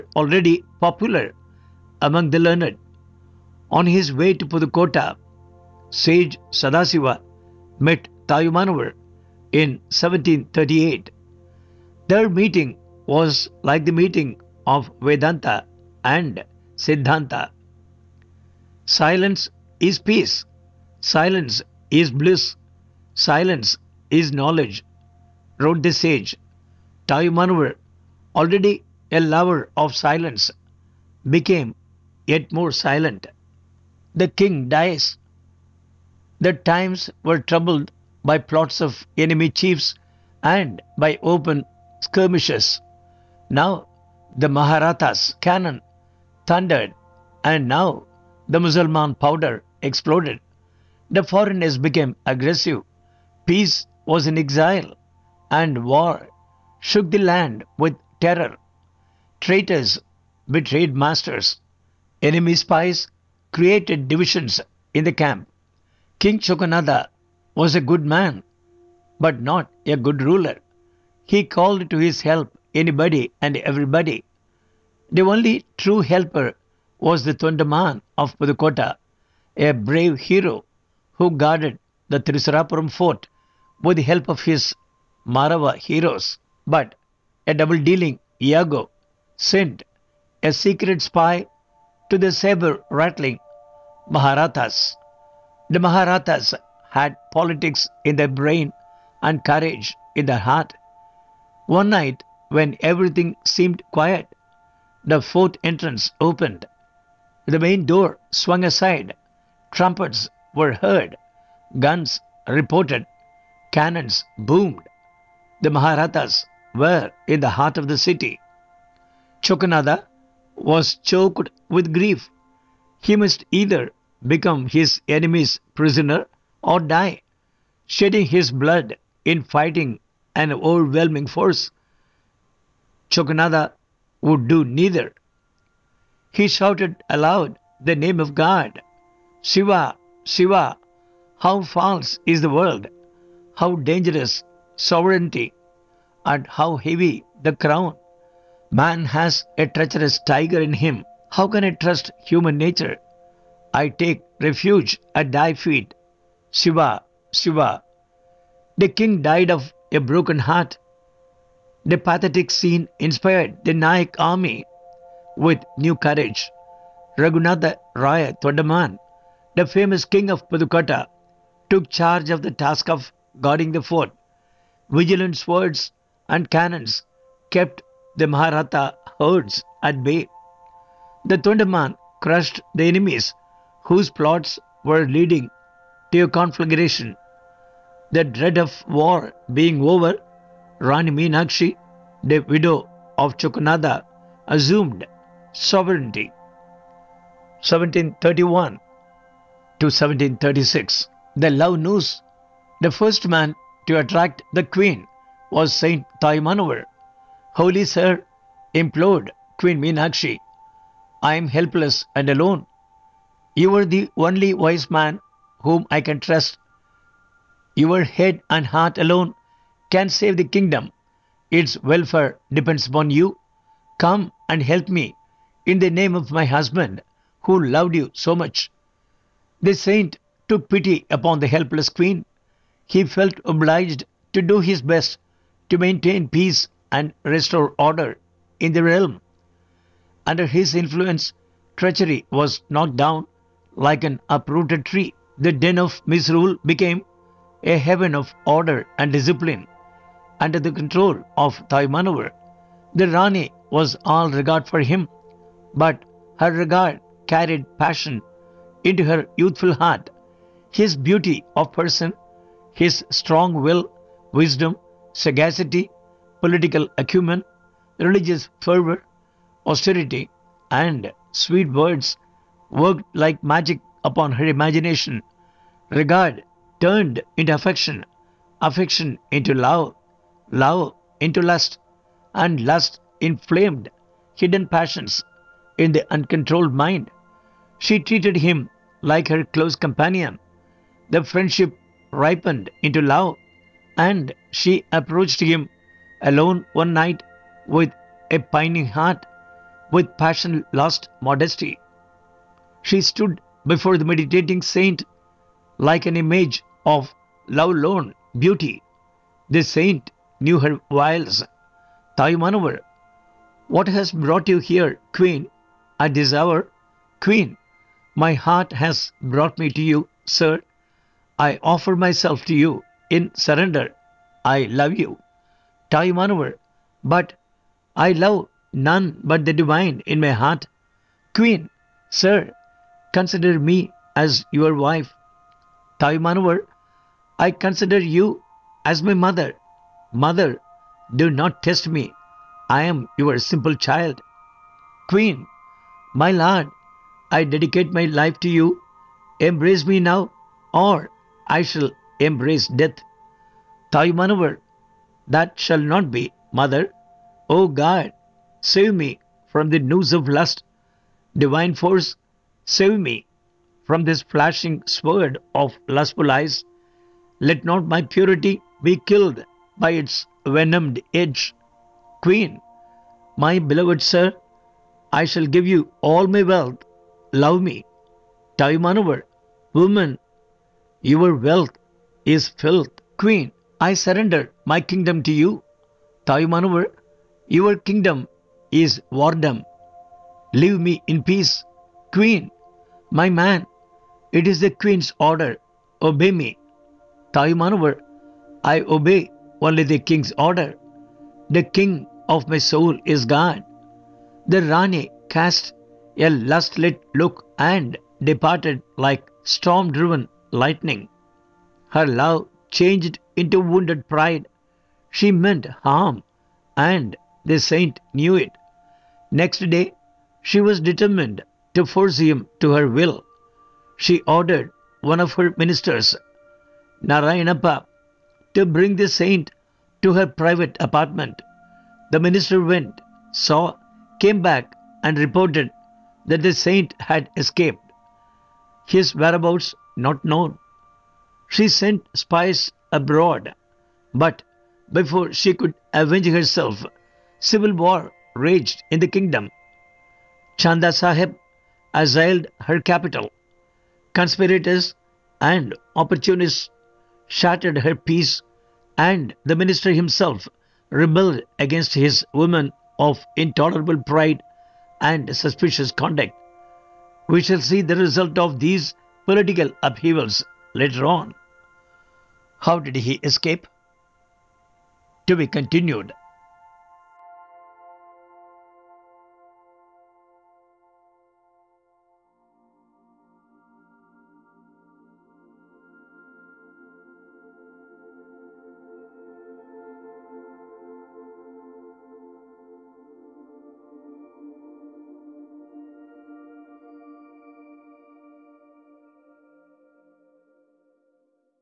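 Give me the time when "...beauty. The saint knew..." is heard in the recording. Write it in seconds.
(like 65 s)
308 s.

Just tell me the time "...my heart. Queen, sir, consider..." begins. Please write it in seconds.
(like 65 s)
330 s.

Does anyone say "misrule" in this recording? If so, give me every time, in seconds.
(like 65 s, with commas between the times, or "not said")
246 s.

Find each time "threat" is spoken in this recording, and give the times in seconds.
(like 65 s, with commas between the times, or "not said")
not said.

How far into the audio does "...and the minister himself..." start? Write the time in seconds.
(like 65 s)
458 s.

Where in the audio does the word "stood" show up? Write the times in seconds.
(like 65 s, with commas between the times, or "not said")
302 s.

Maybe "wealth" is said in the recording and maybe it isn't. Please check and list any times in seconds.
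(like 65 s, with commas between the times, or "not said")
376 s, 381 s.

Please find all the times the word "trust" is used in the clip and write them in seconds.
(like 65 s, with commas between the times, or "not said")
151 s, 216 s.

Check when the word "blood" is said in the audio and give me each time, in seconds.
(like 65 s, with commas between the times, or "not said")
128 s.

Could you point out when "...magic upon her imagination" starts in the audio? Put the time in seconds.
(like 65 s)
273 s.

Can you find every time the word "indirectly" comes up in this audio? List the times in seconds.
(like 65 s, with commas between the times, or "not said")
not said.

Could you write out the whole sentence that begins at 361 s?
Divine force, save me from this flashing sword of lustful eyes.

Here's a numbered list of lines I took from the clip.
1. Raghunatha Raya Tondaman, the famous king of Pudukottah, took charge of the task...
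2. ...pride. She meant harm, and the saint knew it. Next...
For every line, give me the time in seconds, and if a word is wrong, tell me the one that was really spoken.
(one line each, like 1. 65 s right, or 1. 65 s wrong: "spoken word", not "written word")
1. 167 s right
2. 414 s right.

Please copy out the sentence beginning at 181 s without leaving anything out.
The Tondaman crushed the enemies whose plots were leading to a conflagration.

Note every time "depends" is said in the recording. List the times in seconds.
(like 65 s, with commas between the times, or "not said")
222 s.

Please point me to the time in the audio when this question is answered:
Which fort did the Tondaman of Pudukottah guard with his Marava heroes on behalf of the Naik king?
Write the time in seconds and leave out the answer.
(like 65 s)
82 s.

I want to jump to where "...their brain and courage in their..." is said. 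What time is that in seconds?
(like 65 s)
98 s.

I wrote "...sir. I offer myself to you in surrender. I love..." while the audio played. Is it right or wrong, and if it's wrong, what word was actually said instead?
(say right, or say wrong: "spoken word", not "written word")
right.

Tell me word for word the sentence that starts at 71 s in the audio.
He called to his help anybody and everybody.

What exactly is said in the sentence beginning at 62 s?
Enemy spies created divisions in the camp.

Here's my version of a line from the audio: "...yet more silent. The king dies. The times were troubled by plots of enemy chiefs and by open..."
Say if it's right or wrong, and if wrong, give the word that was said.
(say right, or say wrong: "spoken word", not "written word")
right.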